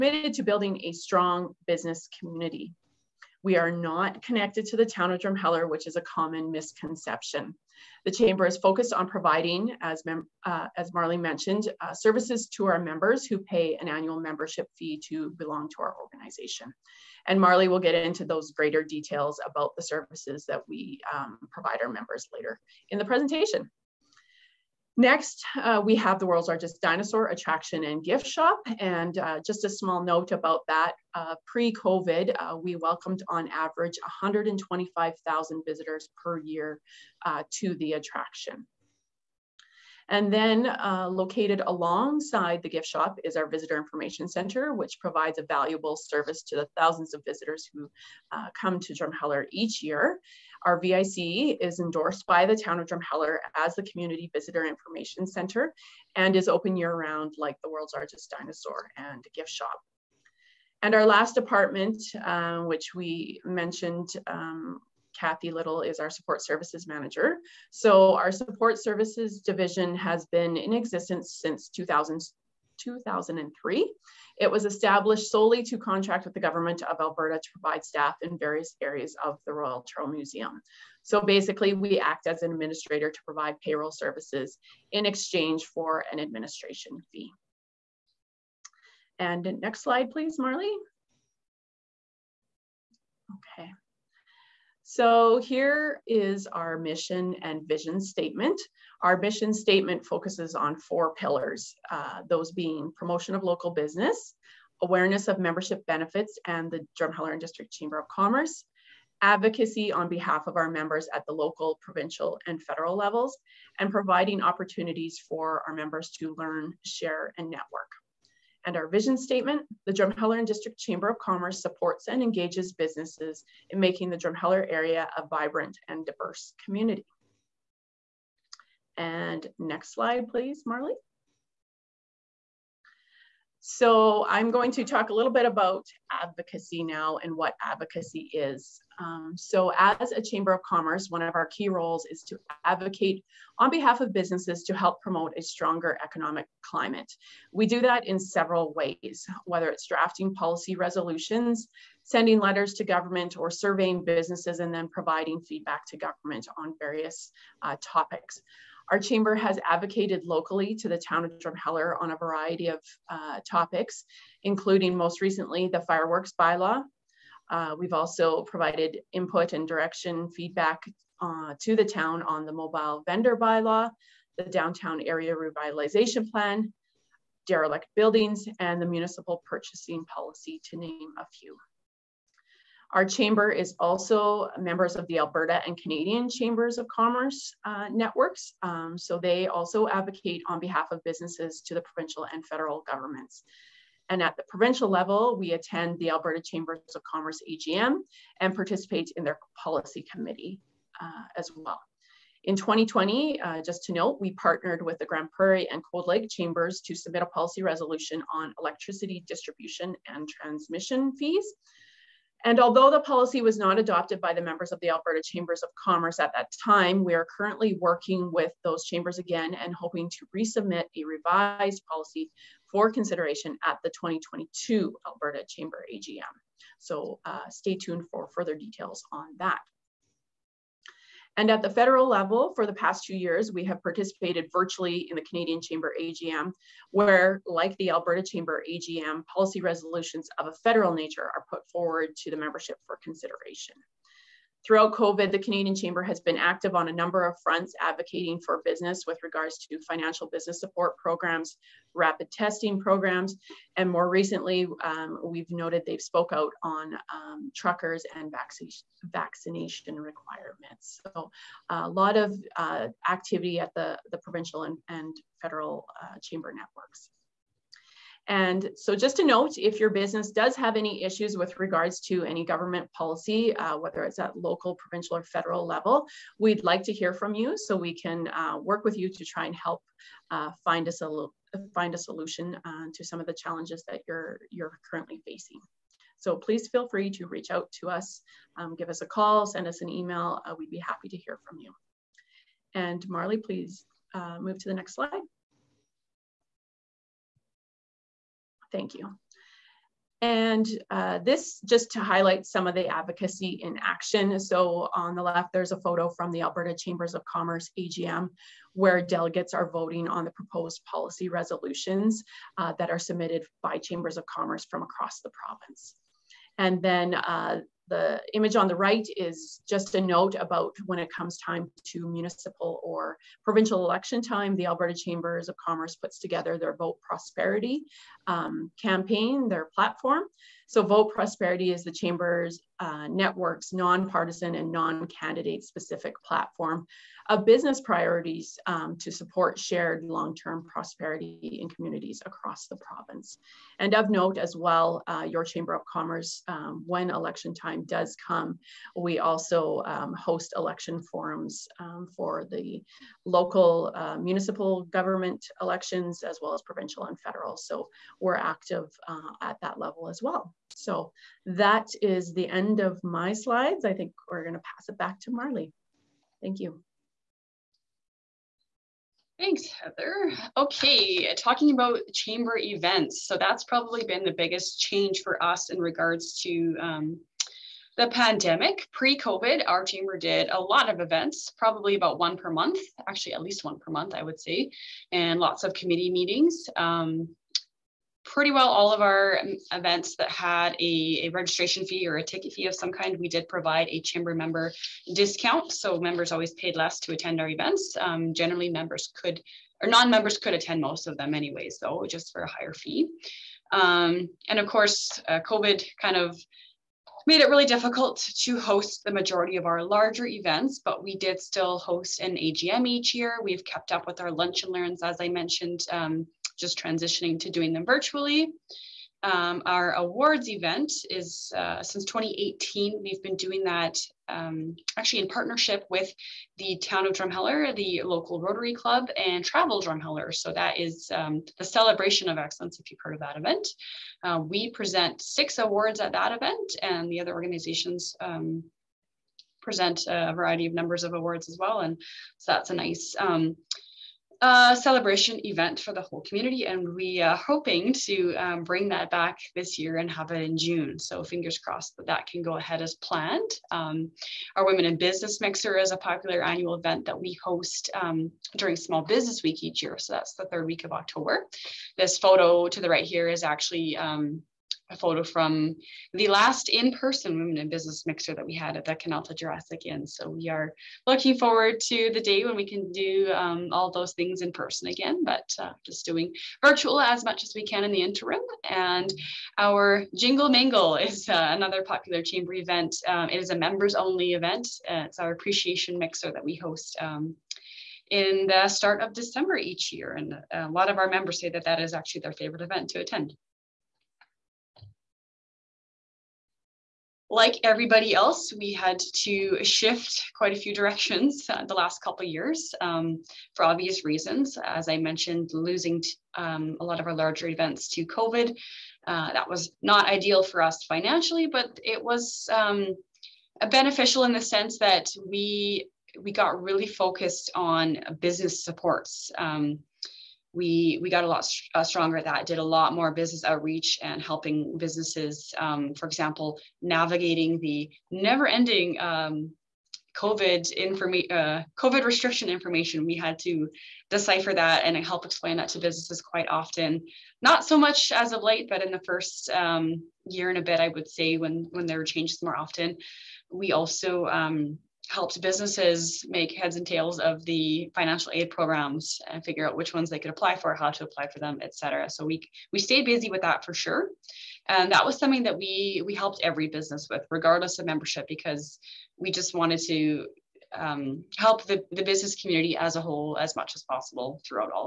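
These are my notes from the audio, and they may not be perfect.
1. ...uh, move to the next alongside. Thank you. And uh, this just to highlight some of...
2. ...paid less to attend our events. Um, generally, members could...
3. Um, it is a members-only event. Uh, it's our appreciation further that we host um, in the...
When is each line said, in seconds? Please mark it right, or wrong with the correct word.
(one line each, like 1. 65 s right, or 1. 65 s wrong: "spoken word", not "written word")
1. 294 s wrong: "slide", not "alongside"
2. 396 s right
3. 483 s wrong: "mixer", not "further".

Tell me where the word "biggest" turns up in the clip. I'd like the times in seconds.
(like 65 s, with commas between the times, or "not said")
374 s.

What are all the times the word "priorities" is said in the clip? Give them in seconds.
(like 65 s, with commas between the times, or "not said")
337 s.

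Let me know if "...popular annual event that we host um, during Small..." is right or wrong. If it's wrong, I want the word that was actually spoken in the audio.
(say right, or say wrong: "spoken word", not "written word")
right.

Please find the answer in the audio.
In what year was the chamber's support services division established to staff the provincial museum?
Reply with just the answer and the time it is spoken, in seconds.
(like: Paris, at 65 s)
2003, at 72 s.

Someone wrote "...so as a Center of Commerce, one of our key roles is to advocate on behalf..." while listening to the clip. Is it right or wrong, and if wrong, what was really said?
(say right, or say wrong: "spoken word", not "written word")
wrong: "Chamber", not "Center".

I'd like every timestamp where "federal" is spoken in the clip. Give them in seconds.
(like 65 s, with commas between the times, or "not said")
112 s, 192 s, 231 s, 240 s, 265 s, 275 s, 357 s.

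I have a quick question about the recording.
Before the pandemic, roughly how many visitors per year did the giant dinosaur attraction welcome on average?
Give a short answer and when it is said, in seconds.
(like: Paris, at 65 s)
125,000, at 34 s.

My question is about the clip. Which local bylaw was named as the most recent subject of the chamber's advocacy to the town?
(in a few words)
fireworks bylaw.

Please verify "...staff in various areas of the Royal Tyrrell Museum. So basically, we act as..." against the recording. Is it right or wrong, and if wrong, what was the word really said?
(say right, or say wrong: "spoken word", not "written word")
right.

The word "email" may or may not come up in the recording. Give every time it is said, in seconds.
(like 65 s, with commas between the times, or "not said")
289 s.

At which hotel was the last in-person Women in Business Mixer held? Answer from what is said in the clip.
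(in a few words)
Canalta Jurassic Inn.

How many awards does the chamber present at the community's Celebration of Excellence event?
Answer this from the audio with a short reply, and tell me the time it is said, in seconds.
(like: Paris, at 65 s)
6, at 435 s.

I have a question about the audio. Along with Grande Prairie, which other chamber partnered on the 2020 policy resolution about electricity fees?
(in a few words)
Cold Lake.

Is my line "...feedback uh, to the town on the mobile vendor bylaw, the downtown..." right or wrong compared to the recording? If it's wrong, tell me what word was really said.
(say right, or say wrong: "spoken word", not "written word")
right.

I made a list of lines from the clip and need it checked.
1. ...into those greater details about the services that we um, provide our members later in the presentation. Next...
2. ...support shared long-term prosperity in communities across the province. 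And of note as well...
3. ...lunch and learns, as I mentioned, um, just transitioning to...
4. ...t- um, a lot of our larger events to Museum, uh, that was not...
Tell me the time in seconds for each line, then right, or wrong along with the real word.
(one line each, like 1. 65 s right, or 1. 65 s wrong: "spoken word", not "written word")
1. 17 s right
2. 339 s right
3. 414 s right
4. 506 s wrong: "COVID", not "Museum".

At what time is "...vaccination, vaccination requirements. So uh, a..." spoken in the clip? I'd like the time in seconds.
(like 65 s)
258 s.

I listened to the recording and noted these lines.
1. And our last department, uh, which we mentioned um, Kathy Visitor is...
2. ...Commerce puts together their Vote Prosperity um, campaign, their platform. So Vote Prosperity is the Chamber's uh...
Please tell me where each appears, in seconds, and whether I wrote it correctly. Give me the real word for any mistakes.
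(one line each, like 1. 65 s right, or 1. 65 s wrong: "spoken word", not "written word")
1. 60 s wrong: "Little", not "Visitor"
2. 325 s right.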